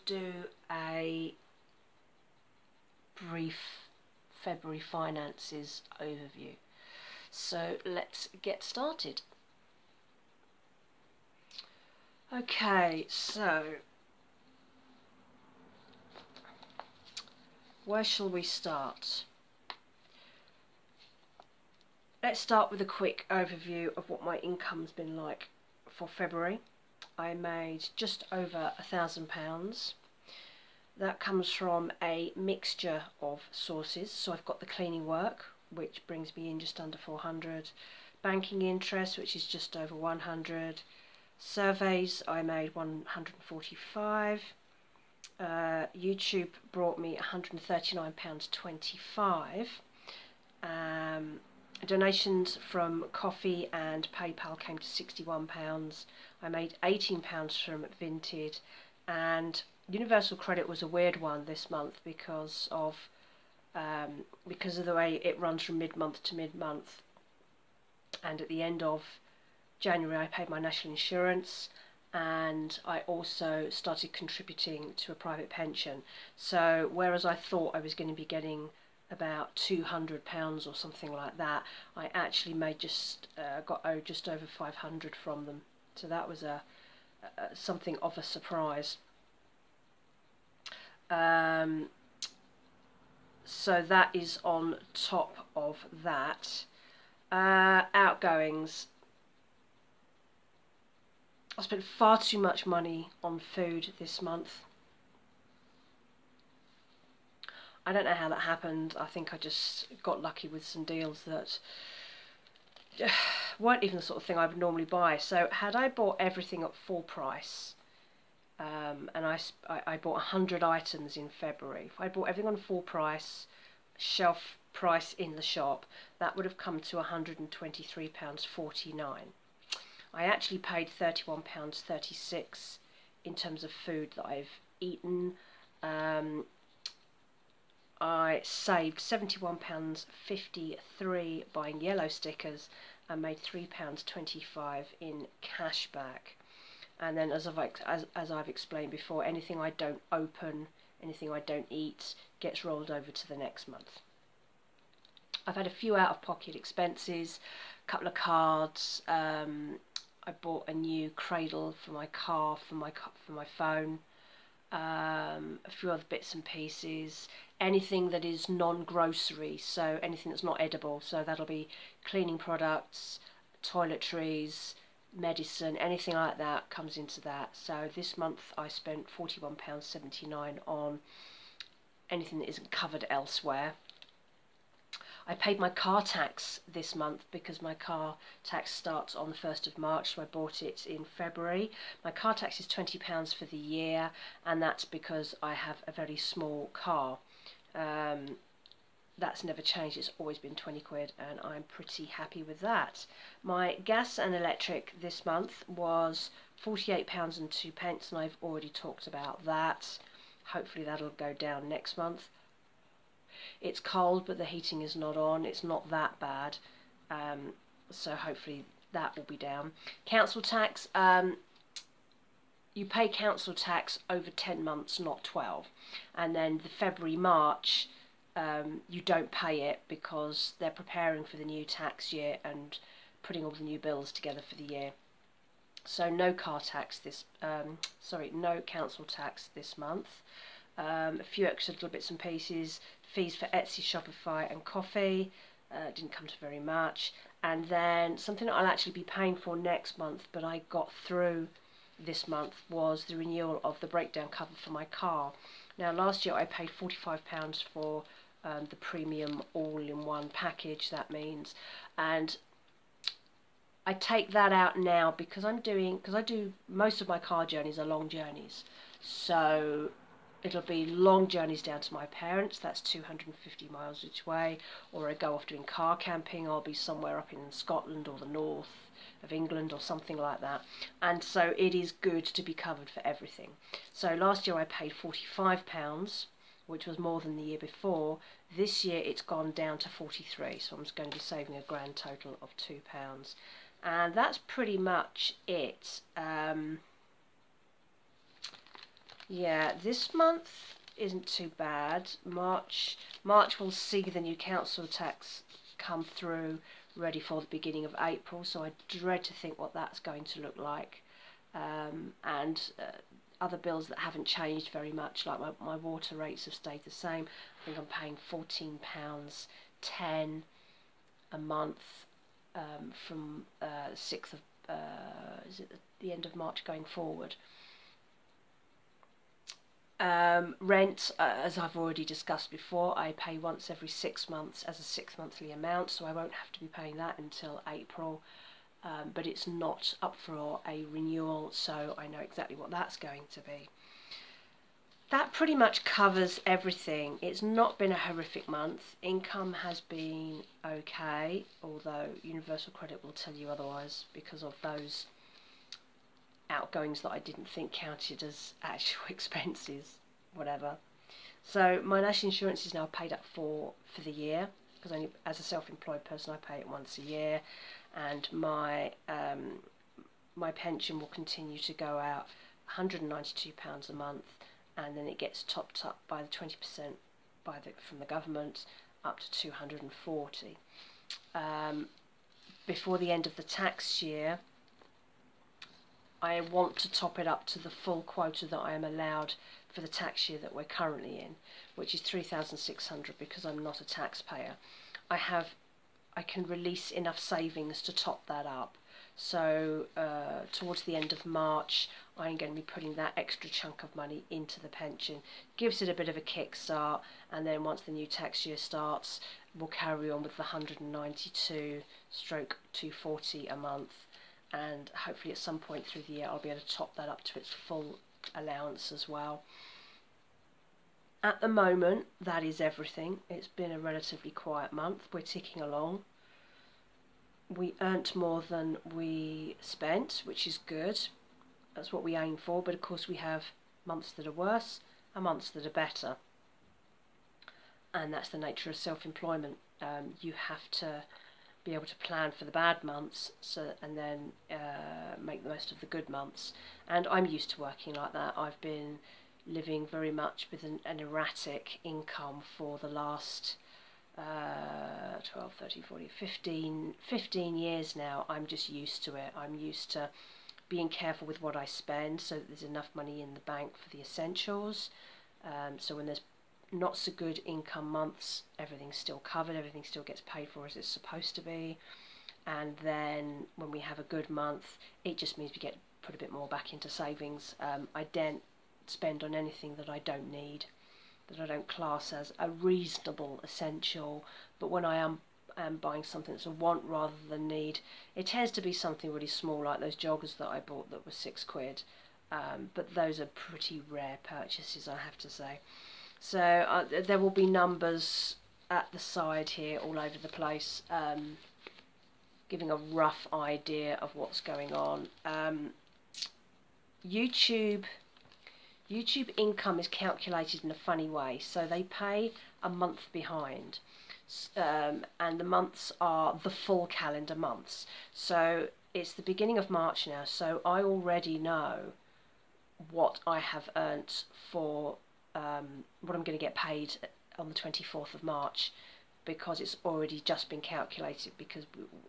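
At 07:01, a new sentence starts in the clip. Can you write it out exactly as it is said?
At the moment, that is everything.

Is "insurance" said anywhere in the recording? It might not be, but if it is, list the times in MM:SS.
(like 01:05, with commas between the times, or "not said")
01:10, 06:02.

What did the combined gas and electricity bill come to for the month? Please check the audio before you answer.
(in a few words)
£48.02.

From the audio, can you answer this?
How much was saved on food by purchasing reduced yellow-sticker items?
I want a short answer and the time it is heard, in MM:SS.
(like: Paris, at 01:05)
£71.53, at 02:18.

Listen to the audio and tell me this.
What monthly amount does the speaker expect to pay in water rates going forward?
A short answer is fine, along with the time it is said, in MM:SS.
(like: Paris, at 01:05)
£14.10, at 05:18.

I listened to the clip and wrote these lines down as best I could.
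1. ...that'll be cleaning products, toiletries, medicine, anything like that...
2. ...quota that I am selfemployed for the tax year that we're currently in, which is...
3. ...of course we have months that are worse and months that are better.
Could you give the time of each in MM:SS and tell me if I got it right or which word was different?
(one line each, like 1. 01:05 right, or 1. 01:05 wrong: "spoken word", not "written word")
1. 02:51 right
2. 06:28 wrong: "allowed", not "selfemployed"
3. 07:12 right.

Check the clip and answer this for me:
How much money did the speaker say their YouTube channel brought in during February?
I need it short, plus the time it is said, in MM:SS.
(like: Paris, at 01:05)
£139.25, at 00:47.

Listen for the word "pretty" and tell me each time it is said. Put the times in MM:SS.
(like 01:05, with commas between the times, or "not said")
03:21, 04:54, 05:45, 08:13.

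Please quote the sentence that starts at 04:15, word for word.
Now last year I paid £45 for um, the premium all-in-one package, that means.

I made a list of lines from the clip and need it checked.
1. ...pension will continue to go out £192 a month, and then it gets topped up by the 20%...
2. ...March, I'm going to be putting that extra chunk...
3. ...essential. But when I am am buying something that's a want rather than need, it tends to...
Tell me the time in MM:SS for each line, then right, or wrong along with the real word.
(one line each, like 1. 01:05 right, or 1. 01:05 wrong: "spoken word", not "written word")
1. 06:10 right
2. 06:41 right
3. 08:03 right.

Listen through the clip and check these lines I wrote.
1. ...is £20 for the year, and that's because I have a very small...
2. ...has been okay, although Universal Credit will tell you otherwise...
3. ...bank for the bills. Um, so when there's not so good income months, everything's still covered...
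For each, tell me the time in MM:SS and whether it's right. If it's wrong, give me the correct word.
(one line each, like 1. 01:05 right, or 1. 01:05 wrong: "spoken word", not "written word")
1. 03:12 right
2. 05:49 right
3. 07:43 wrong: "essentials", not "bills".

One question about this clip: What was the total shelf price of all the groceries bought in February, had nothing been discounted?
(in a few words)
£123.49.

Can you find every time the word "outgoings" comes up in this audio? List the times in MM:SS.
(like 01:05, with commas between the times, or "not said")
01:37, 05:56.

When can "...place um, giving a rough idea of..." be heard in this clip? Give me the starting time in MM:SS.
08:20.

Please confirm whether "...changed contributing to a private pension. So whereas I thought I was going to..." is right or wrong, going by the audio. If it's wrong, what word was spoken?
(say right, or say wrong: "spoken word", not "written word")
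wrong: "started", not "changed".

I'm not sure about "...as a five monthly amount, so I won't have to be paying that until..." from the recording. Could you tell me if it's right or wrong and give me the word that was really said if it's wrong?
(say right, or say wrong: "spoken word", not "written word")
wrong: "six", not "five".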